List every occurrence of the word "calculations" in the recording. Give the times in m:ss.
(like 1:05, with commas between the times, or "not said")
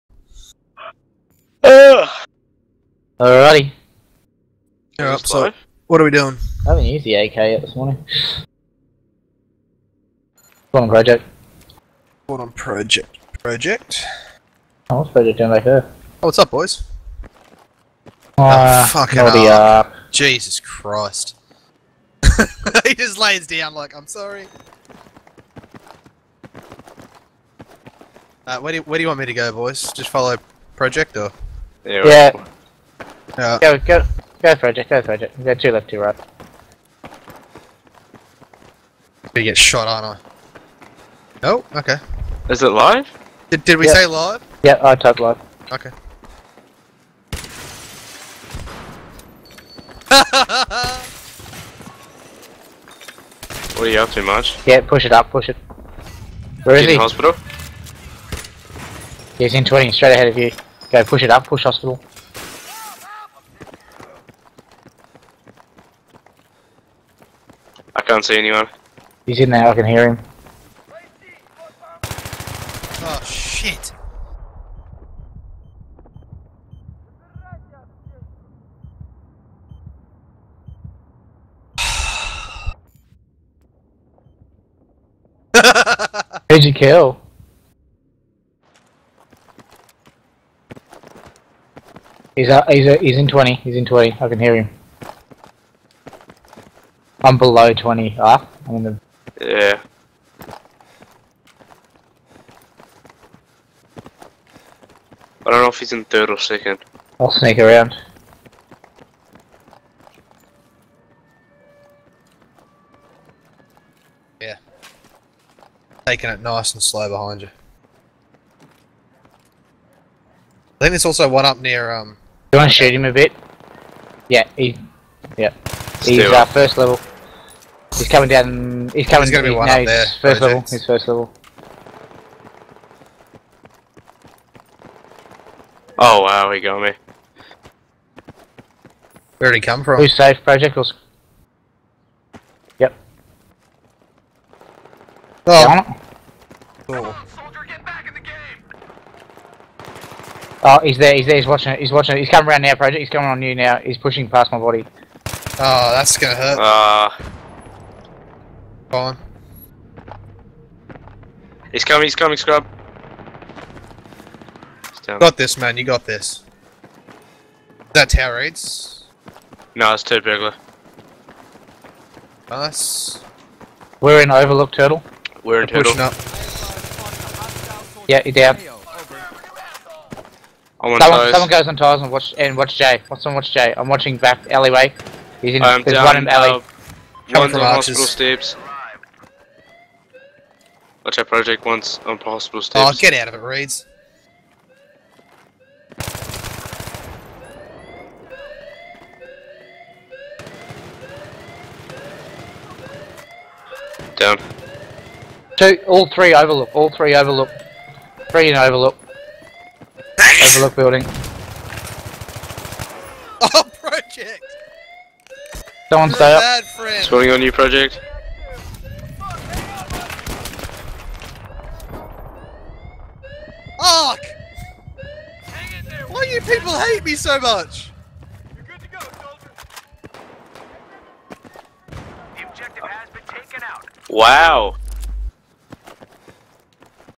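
not said.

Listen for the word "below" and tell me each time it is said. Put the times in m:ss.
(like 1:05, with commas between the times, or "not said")
1:37.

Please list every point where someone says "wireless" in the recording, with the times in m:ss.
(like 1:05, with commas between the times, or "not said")
not said.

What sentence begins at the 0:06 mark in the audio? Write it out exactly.
I haven't used the AK yet this morning.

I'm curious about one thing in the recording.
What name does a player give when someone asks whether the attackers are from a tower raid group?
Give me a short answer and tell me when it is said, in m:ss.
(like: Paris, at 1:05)
turd burglar, at 2:50.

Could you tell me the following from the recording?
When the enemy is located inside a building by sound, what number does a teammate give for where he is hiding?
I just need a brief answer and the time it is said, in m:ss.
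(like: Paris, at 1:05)
20, at 0:59.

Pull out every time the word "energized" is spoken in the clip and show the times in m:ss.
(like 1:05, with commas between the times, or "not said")
not said.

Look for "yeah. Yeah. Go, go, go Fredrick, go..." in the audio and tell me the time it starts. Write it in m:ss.
0:32.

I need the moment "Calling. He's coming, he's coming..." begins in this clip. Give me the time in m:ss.
2:38.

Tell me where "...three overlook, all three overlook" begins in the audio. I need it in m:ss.
3:26.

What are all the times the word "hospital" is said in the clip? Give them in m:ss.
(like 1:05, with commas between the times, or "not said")
0:56, 1:01, 3:07.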